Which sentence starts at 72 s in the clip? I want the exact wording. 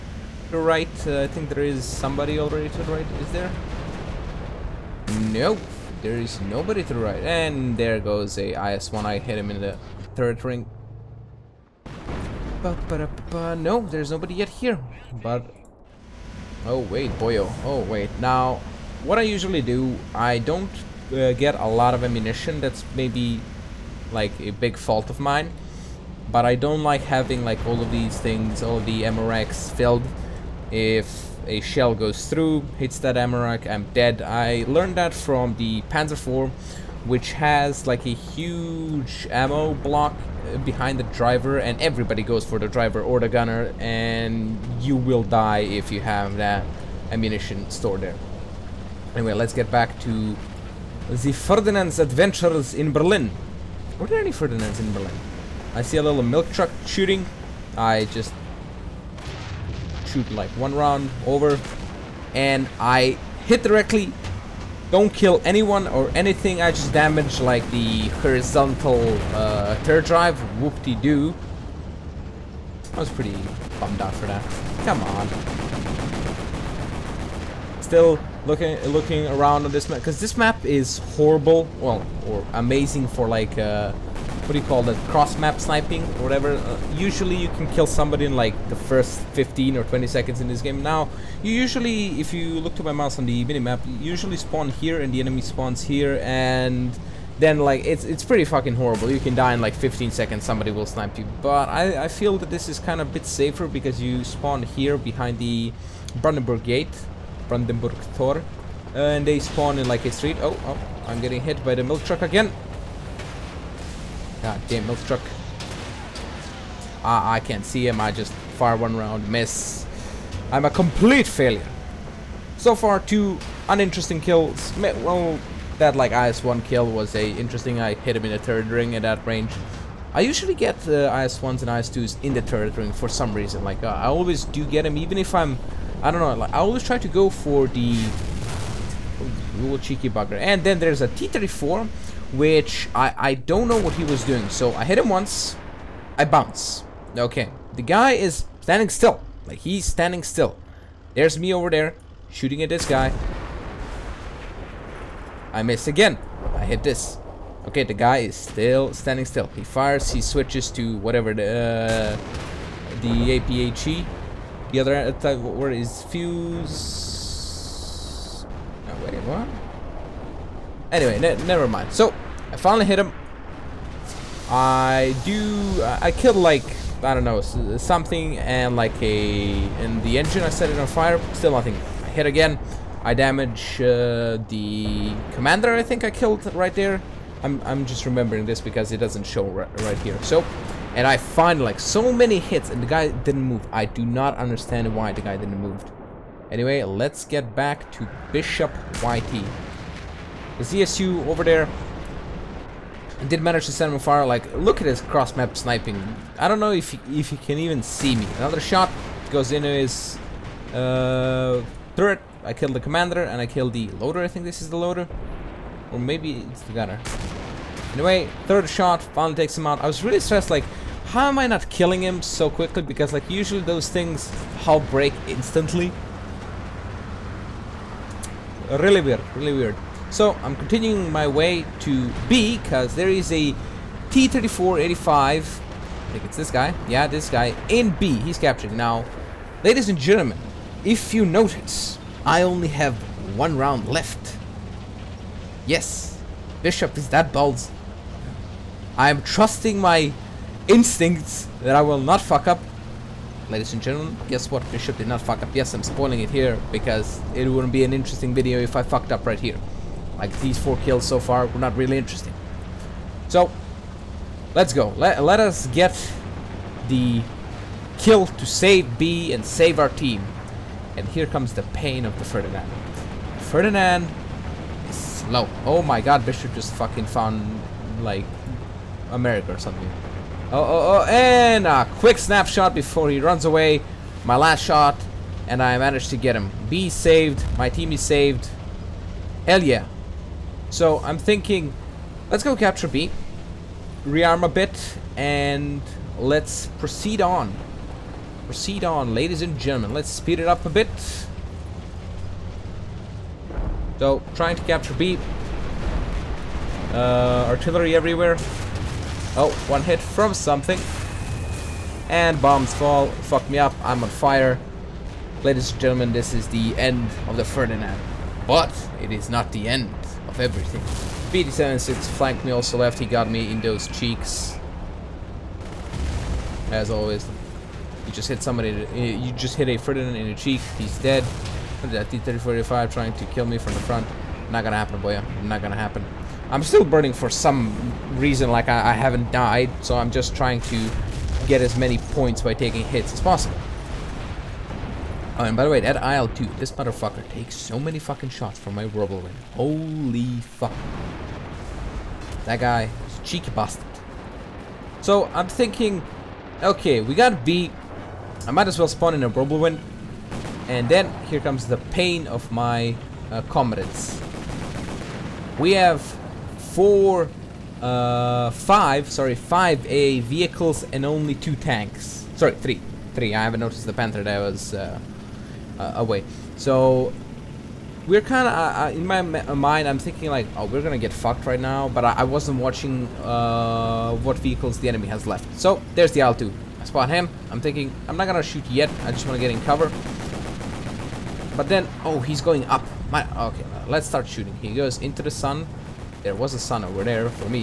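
I was pretty bummed out for that.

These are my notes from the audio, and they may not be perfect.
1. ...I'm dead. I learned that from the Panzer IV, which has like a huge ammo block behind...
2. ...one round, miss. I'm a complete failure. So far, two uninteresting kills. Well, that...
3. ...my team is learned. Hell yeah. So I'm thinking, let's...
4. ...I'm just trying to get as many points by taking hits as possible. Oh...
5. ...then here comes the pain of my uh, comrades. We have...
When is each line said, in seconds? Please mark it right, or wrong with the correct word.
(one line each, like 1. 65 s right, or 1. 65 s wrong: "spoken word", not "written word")
1. 33 s right
2. 118 s right
3. 287 s wrong: "saved", not "learned"
4. 339 s right
5. 360 s right.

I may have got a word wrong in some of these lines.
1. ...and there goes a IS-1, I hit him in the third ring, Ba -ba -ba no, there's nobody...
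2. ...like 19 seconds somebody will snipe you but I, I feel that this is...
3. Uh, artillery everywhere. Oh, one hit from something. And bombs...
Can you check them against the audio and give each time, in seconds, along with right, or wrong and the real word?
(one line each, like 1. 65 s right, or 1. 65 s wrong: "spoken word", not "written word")
1. 7 s right
2. 99 s wrong: "15", not "19"
3. 306 s right.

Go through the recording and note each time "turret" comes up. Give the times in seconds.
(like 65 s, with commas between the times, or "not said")
69 s, 211 s.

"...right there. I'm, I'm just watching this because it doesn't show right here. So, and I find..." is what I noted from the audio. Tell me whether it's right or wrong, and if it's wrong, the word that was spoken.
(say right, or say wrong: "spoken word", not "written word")
wrong: "remembering", not "watching".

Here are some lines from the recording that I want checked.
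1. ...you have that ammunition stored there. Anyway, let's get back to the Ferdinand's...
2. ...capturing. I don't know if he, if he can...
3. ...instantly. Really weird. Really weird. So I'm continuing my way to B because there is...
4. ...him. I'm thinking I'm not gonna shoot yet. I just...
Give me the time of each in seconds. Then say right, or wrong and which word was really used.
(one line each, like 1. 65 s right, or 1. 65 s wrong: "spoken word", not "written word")
1. 45 s right
2. 205 s wrong: "sniping", not "capturing"
3. 225 s right
4. 387 s right.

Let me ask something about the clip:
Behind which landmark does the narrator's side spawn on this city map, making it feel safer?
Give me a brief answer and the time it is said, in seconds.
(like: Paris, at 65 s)
Brandenburg Gate, at 106 s.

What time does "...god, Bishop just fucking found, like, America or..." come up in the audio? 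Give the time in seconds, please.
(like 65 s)
275 s.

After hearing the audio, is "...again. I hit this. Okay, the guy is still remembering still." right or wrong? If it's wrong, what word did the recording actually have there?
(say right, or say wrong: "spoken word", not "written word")
wrong: "standing", not "remembering".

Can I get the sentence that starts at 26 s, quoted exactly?
But I don't like having like all of these things, all of the ammo racks filled.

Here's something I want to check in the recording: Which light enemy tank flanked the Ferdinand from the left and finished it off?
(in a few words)
PT-76.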